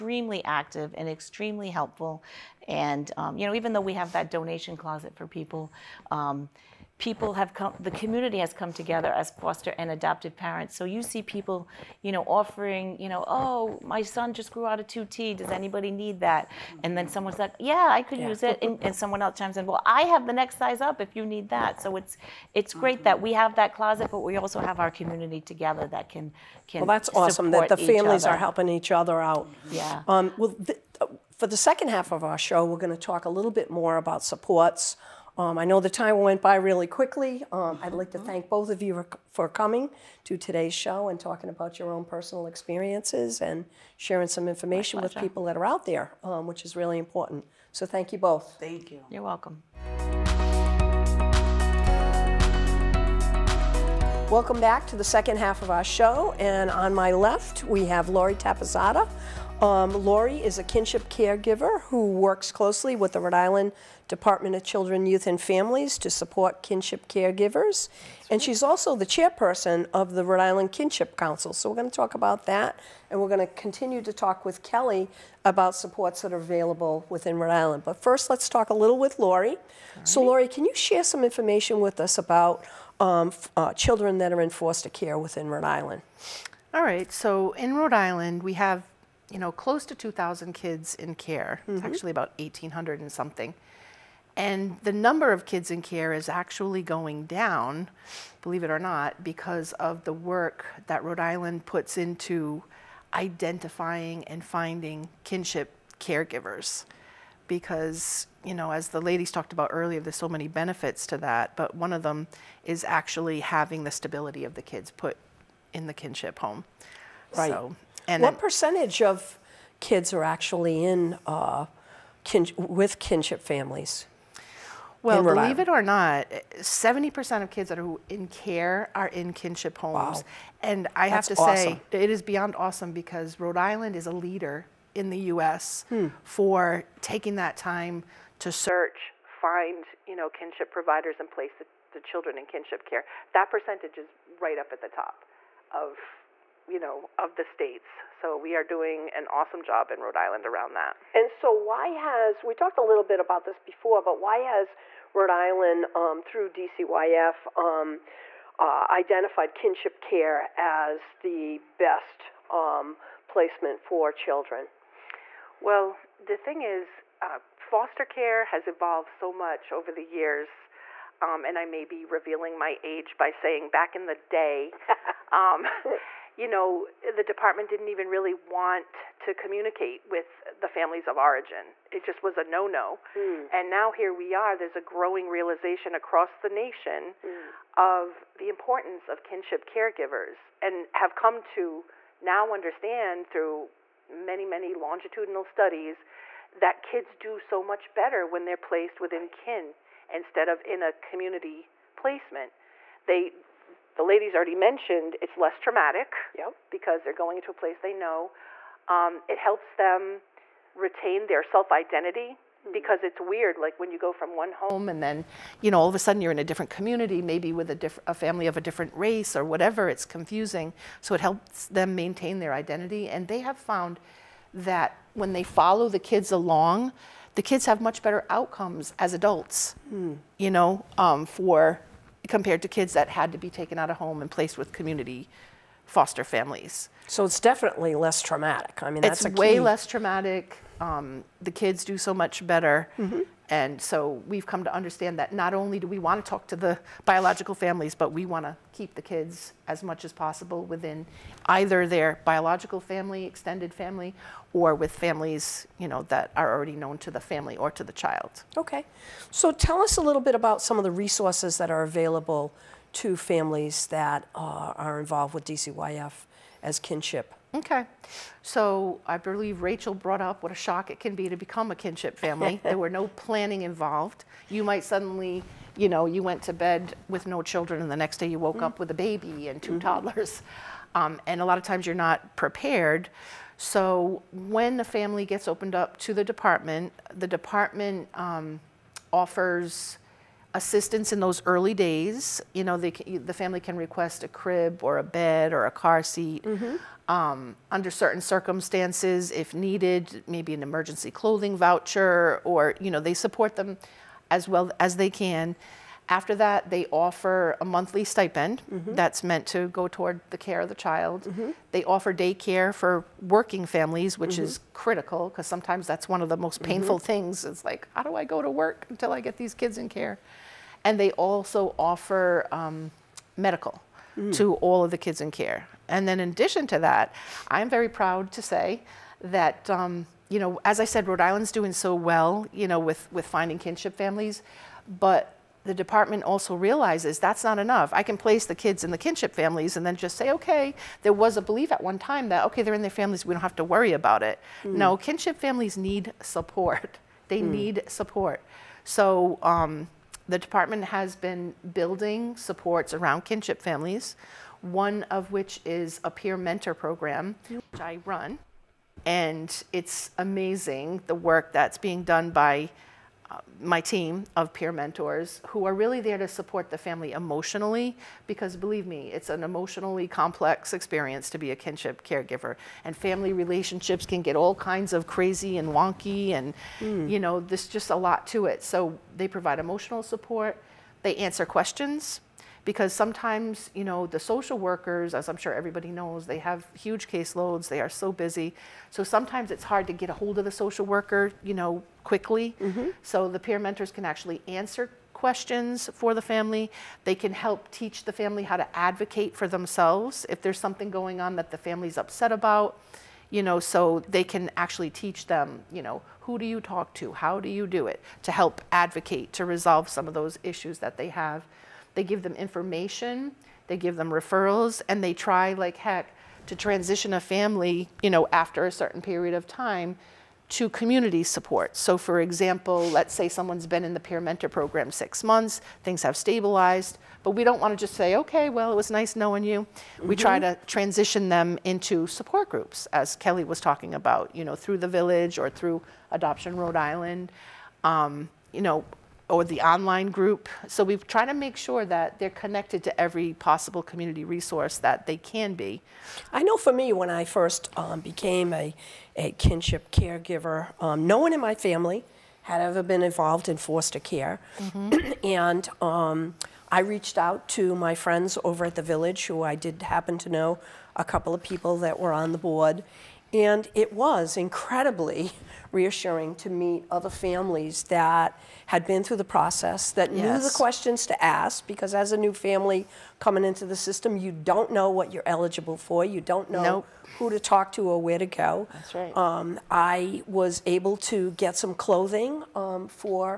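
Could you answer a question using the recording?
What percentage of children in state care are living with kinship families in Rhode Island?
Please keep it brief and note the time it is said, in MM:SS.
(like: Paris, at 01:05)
70%, at 02:06.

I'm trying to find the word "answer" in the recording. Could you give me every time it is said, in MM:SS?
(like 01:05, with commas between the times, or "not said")
06:21, 06:34.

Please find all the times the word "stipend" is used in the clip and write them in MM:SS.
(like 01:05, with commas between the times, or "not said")
05:08.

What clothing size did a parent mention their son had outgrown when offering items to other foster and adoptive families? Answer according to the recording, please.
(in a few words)
2T.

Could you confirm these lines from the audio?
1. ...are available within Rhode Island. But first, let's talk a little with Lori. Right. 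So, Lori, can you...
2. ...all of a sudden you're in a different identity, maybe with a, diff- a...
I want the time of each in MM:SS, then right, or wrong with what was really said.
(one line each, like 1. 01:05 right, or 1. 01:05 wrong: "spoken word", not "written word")
1. 01:16 right
2. 03:35 wrong: "community", not "identity".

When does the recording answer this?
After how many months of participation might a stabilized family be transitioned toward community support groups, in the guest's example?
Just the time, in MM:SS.
07:04.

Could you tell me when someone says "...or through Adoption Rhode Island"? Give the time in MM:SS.
07:15.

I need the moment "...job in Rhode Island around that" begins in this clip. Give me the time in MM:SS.
02:29.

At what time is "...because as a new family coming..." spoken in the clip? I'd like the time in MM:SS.
07:51.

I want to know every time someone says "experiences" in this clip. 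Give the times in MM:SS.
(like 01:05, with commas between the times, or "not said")
00:42, 06:10.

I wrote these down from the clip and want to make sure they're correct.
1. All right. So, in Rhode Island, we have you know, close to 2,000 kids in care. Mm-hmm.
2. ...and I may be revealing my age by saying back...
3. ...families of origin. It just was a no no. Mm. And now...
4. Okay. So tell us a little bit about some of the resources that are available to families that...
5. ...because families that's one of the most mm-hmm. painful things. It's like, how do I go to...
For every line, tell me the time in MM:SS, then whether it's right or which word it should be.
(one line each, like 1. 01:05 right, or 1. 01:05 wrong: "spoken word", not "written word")
1. 01:26 right
2. 02:51 right
3. 03:00 right
4. 04:18 right
5. 05:15 wrong: "sometimes", not "families".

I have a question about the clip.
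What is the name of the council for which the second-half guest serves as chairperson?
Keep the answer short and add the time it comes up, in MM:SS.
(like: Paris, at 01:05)
Rhode Island Kinship Council, at 01:10.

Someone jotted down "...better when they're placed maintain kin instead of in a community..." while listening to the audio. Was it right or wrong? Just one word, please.
wrong.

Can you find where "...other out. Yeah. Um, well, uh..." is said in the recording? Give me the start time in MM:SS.
00:28.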